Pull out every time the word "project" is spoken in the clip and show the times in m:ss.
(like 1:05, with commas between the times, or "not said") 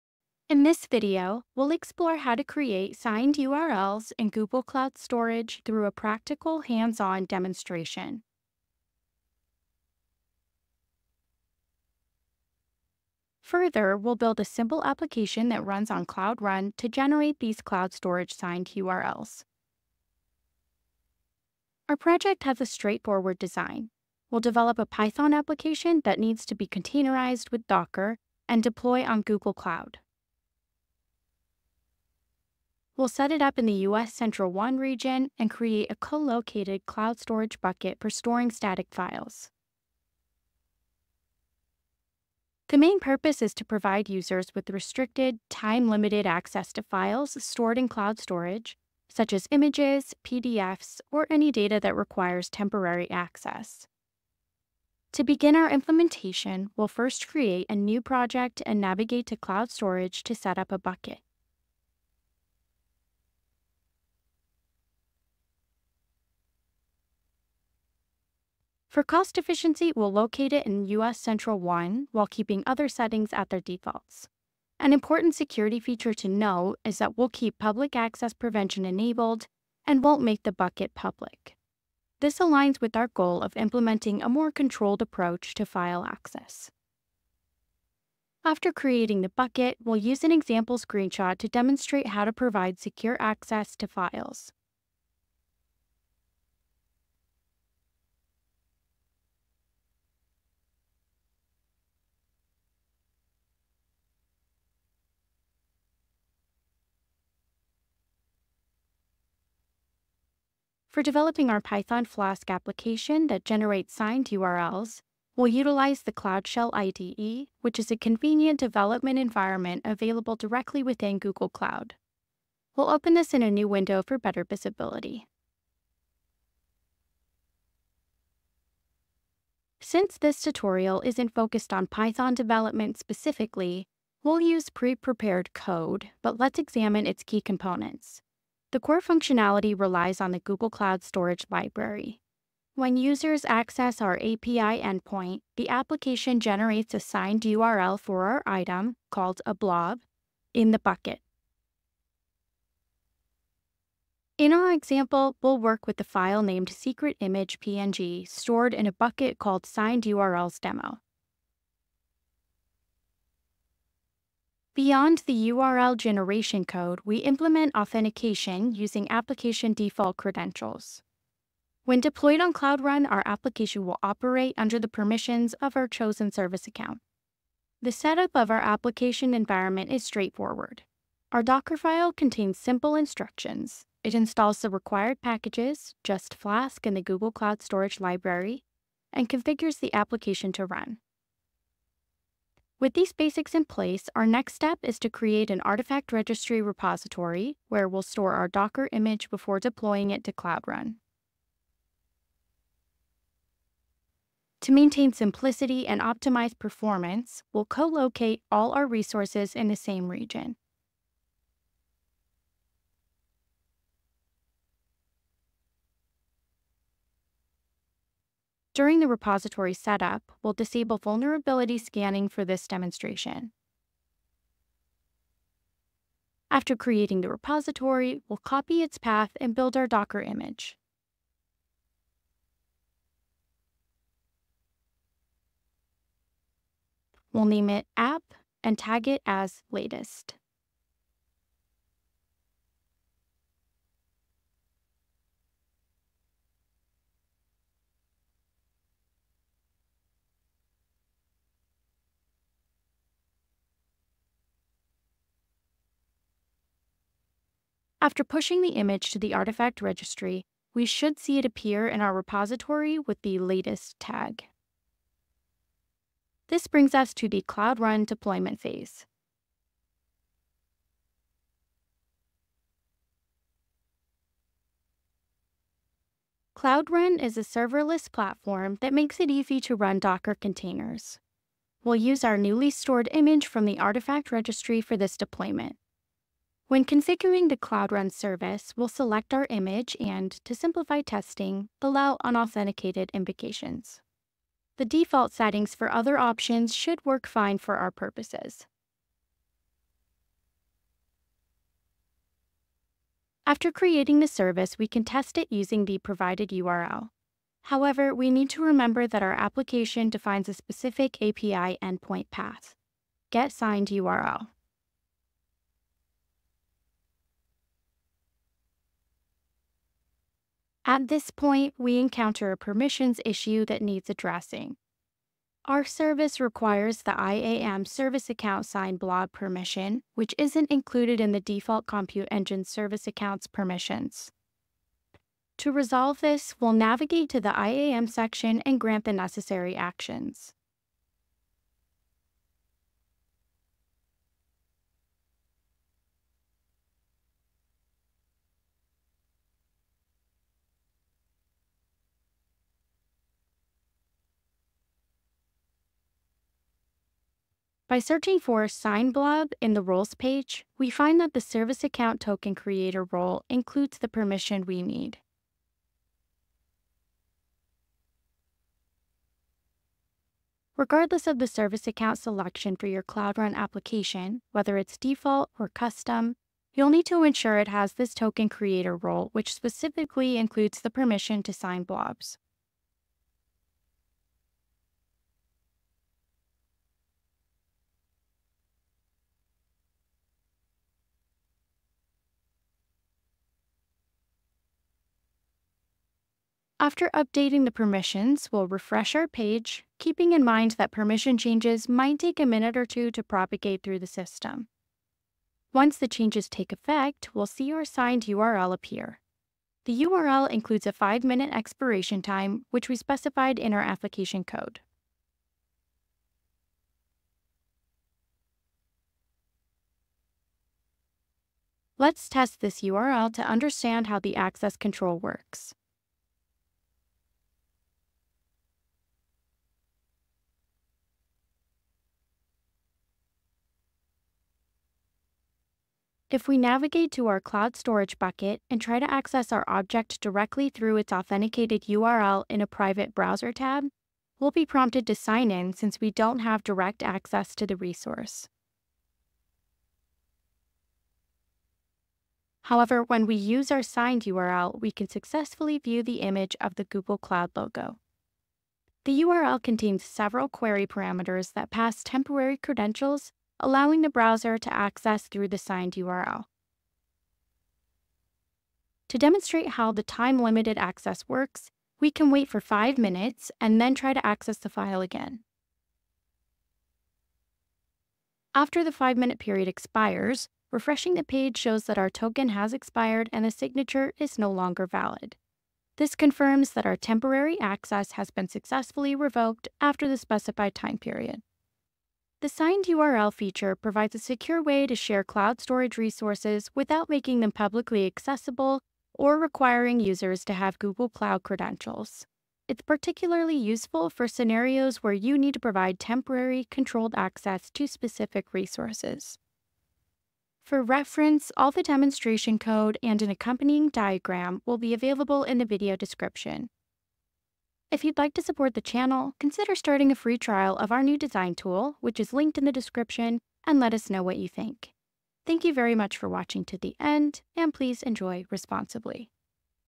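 0:21, 0:57.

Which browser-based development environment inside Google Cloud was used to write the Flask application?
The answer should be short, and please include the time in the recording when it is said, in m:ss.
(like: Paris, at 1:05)
Cloud Shell IDE, at 1:56.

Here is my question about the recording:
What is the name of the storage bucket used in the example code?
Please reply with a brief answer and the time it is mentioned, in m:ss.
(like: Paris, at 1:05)
signed URLs demo, at 2:39.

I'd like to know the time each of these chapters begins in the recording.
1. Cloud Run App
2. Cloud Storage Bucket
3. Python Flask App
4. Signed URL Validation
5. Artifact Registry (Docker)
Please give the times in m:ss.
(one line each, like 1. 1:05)
1. 4:25
2. 1:02
3. 1:50
4. 7:01
5. 3:12.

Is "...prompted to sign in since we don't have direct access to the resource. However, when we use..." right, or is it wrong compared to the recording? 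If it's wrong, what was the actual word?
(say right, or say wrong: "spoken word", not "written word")
right.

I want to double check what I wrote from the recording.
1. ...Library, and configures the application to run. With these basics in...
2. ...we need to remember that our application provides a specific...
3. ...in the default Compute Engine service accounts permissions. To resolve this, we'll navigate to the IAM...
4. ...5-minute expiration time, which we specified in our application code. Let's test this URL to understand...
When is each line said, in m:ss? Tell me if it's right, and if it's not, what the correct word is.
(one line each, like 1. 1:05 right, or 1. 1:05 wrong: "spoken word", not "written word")
1. 3:07 right
2. 5:08 wrong: "defines", not "provides"
3. 5:31 right
4. 6:50 right.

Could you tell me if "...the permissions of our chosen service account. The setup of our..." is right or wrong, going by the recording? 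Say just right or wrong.
right.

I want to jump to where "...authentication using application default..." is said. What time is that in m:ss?
2:47.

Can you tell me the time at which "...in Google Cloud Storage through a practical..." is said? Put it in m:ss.
0:04.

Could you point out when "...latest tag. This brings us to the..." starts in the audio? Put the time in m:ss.
4:23.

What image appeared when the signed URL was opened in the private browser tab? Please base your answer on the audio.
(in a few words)
Google Cloud logo.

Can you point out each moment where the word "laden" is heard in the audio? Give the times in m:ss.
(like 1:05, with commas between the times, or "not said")
not said.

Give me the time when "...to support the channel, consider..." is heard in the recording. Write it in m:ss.
8:38.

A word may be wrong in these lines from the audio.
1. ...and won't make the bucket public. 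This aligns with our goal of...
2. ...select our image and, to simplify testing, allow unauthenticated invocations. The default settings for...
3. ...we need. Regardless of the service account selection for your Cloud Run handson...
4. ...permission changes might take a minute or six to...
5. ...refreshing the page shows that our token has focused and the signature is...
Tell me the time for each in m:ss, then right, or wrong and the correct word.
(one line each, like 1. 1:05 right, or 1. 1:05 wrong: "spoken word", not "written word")
1. 1:19 right
2. 4:48 right
3. 6:04 wrong: "application", not "handson"
4. 6:40 wrong: "two", not "six"
5. 8:00 wrong: "expired", not "focused".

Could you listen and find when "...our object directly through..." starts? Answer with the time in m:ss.
7:19.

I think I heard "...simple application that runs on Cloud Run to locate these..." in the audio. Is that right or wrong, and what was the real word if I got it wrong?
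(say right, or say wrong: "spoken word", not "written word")
wrong: "generate", not "locate".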